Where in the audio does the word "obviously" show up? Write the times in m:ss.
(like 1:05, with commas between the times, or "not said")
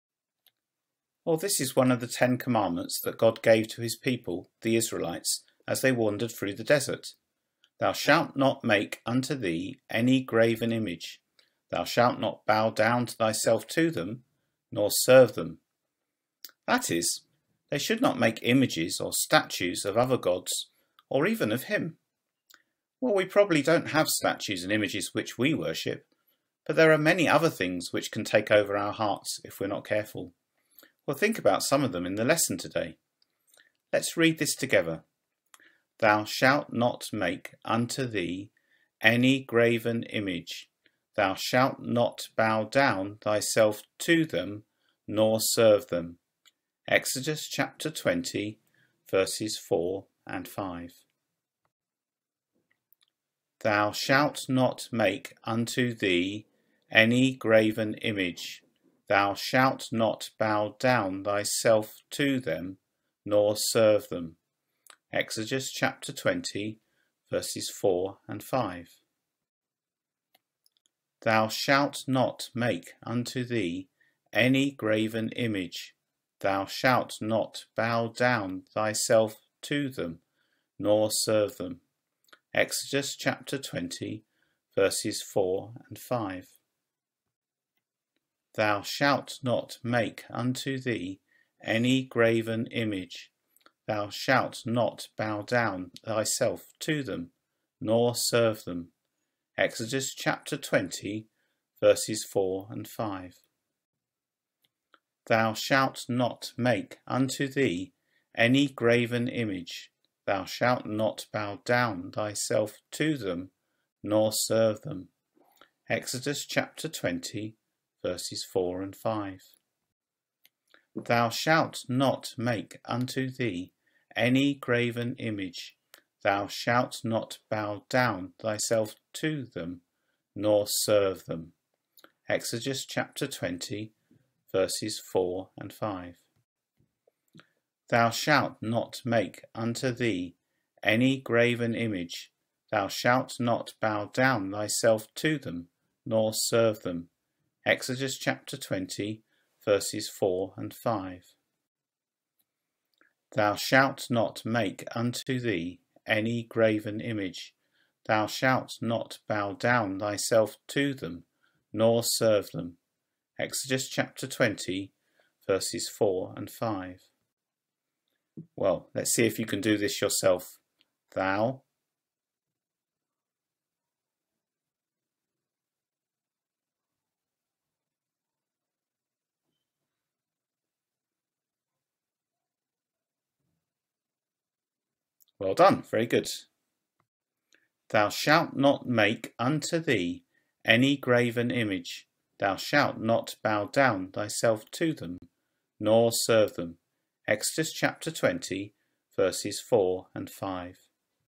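not said.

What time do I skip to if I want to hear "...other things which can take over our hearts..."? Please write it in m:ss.
0:27.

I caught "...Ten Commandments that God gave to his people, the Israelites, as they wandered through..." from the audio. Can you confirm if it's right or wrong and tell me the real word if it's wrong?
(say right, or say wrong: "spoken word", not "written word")
right.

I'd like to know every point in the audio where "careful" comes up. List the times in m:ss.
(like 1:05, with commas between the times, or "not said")
0:29.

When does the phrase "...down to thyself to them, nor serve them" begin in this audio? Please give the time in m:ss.
0:12.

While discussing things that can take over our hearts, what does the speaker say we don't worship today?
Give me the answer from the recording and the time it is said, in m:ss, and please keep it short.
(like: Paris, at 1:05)
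statues and images, at 0:24.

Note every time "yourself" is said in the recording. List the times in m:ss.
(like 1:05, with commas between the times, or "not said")
2:50.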